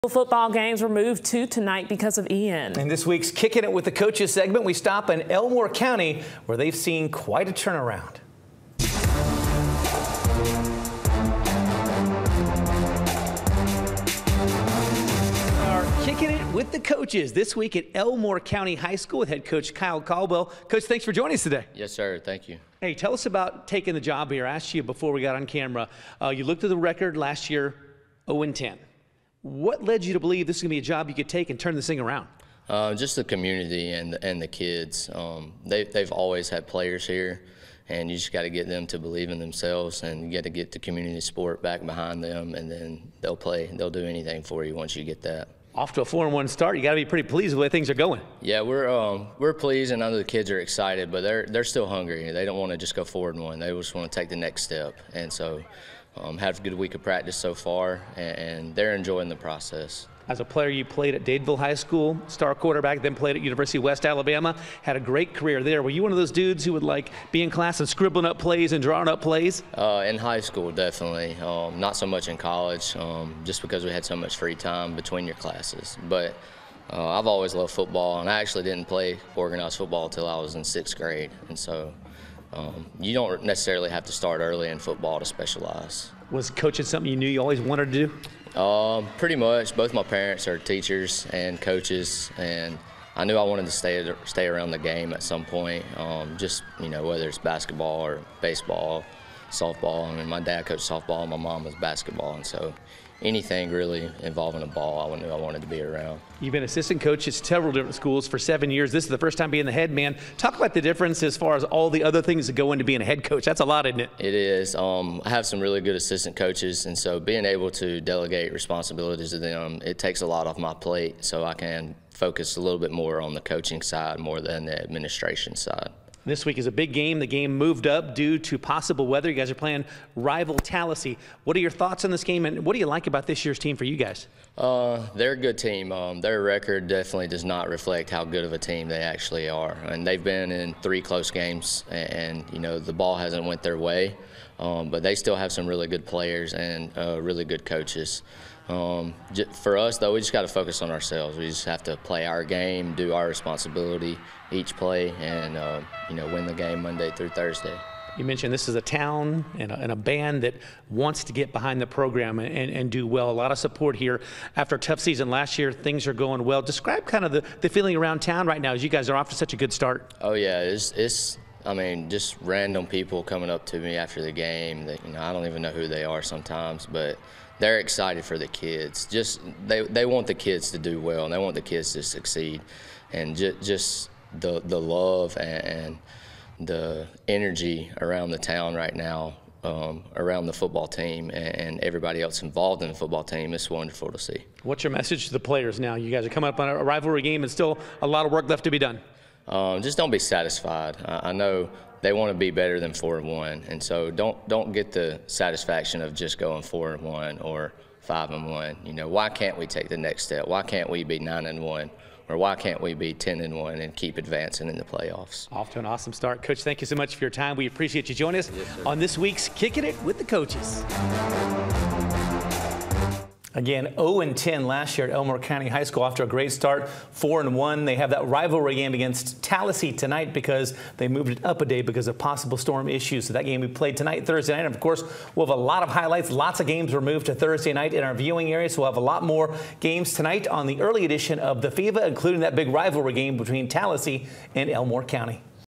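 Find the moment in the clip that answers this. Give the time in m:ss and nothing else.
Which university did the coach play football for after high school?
1:03.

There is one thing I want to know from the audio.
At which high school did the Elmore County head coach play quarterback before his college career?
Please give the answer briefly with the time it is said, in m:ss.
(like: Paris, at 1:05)
Dadeville High School, at 1:01.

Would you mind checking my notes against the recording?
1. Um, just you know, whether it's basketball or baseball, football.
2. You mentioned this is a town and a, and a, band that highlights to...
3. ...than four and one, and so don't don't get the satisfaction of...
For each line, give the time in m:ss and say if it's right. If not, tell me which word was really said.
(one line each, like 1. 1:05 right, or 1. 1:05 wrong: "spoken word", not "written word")
1. 1:35 wrong: "softball", not "football"
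2. 2:38 wrong: "wants", not "highlights"
3. 3:22 right.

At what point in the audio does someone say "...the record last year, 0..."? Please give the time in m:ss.
0:26.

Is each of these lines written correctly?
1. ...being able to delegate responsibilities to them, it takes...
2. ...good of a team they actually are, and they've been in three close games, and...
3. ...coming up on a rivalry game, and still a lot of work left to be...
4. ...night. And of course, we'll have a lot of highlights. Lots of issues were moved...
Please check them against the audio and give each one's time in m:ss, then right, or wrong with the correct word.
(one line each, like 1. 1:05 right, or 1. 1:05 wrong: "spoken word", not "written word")
1. 1:57 right
2. 2:18 right
3. 3:16 right
4. 3:54 wrong: "games", not "issues".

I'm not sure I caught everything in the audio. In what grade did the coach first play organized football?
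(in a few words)
Sixth grade.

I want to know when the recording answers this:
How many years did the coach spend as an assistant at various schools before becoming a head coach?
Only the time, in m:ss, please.
1:48.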